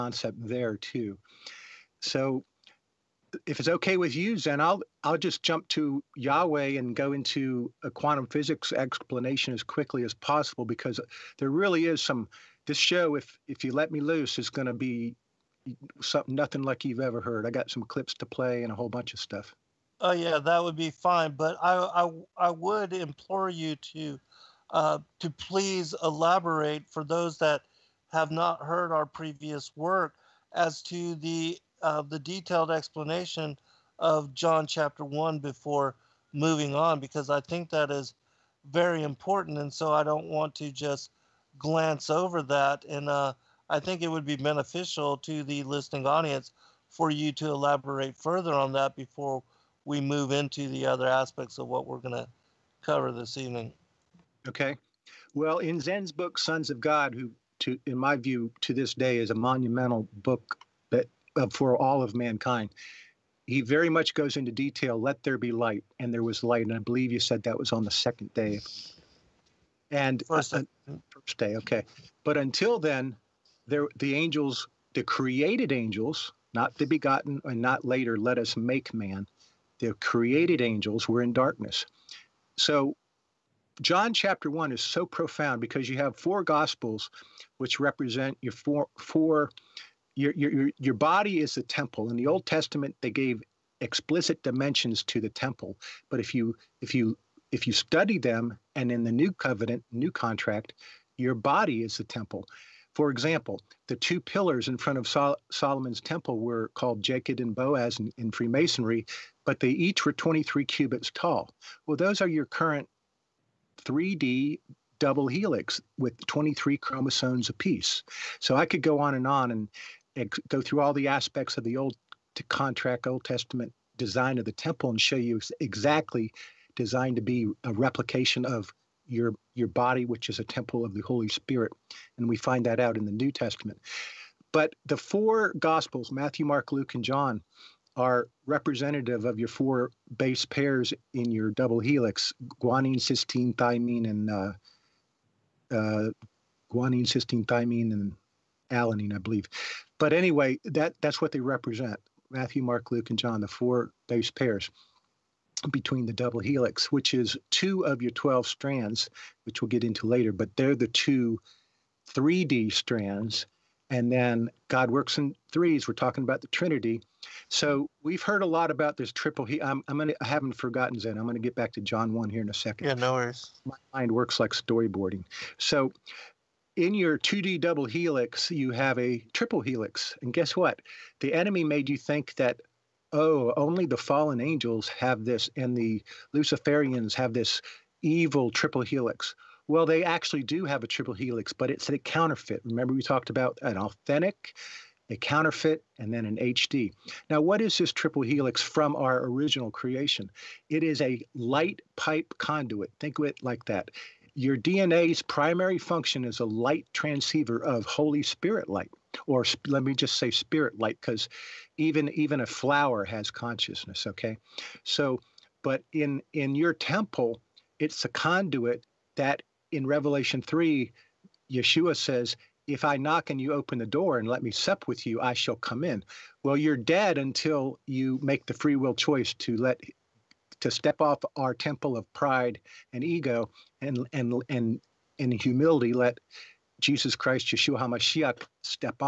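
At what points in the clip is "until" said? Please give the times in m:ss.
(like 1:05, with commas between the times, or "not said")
1:12, 3:47.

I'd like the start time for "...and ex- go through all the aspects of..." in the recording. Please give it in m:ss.
1:59.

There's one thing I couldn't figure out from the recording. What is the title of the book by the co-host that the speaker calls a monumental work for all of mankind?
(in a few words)
Sons of God.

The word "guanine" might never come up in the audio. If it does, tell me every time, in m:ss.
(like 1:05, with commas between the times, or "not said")
2:22, 2:26.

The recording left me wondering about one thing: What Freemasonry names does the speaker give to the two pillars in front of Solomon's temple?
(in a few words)
Jachin and Boaz.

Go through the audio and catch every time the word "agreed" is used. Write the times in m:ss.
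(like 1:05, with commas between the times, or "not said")
not said.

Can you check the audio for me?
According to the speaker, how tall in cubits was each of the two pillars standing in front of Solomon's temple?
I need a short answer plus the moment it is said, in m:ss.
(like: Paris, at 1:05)
23, at 1:50.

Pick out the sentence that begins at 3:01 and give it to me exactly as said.
The enemy made you think that.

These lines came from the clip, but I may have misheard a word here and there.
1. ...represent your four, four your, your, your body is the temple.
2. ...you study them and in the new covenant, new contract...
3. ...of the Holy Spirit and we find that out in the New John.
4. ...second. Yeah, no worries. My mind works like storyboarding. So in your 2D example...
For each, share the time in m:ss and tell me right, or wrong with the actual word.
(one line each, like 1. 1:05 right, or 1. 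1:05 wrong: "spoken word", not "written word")
1. 1:27 right
2. 1:37 right
3. 2:10 wrong: "Testament", not "John"
4. 2:52 wrong: "double", not "example".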